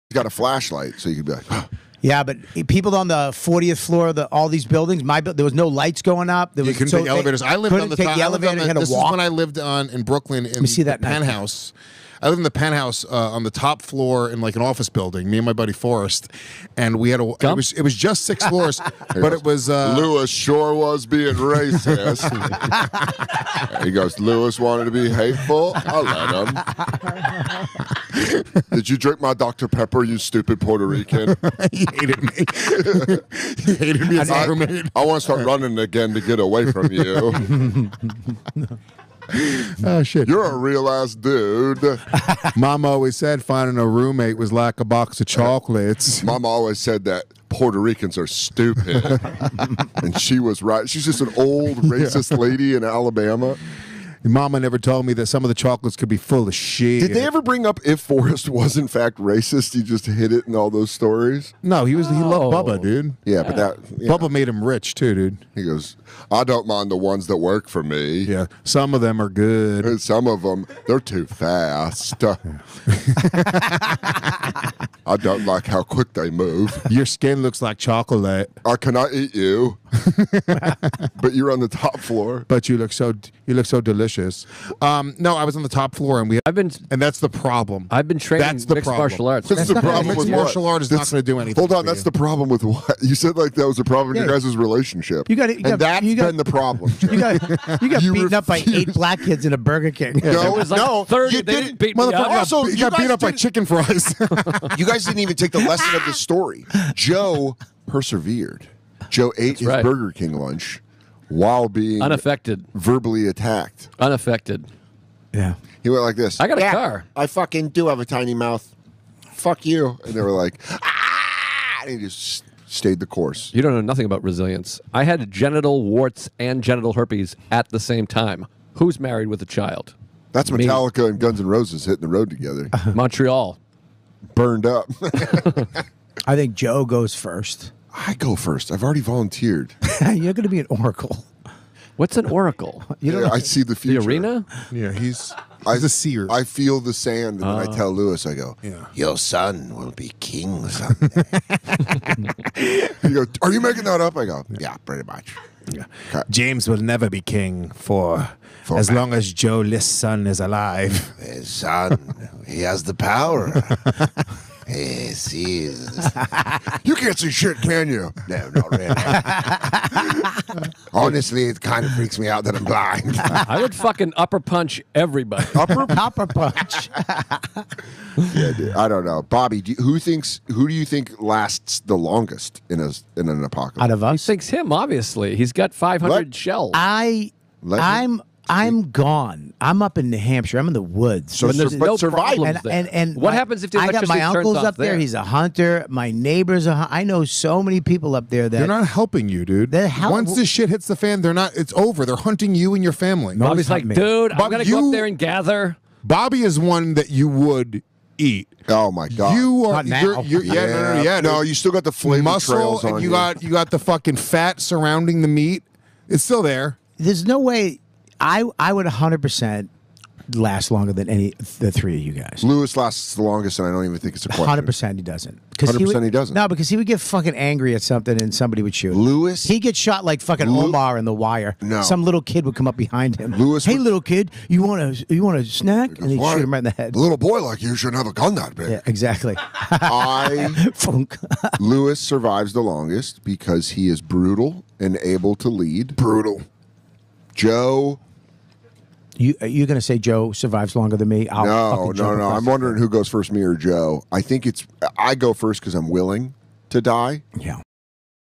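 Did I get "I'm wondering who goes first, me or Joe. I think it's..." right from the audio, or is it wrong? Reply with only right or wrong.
right.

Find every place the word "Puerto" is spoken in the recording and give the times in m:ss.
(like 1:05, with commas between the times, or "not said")
0:30, 0:47.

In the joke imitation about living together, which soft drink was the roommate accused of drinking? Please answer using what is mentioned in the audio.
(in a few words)
Dr Pepper.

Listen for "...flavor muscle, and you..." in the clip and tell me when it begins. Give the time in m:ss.
3:31.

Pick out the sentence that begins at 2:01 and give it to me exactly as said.
And he just stayed the course.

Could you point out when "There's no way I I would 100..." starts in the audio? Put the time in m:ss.
3:36.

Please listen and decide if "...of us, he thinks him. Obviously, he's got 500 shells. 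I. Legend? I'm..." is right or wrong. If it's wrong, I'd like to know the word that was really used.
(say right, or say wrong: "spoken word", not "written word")
right.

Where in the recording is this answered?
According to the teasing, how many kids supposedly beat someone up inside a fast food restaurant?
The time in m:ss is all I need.
1:38.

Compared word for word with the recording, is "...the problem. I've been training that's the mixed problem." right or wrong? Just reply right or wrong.
right.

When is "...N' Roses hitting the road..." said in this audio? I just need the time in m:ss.
2:11.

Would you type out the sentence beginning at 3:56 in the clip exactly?
A little boy like you shouldn't have a gun that big.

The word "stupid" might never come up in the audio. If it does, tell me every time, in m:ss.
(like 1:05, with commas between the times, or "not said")
0:30, 0:48.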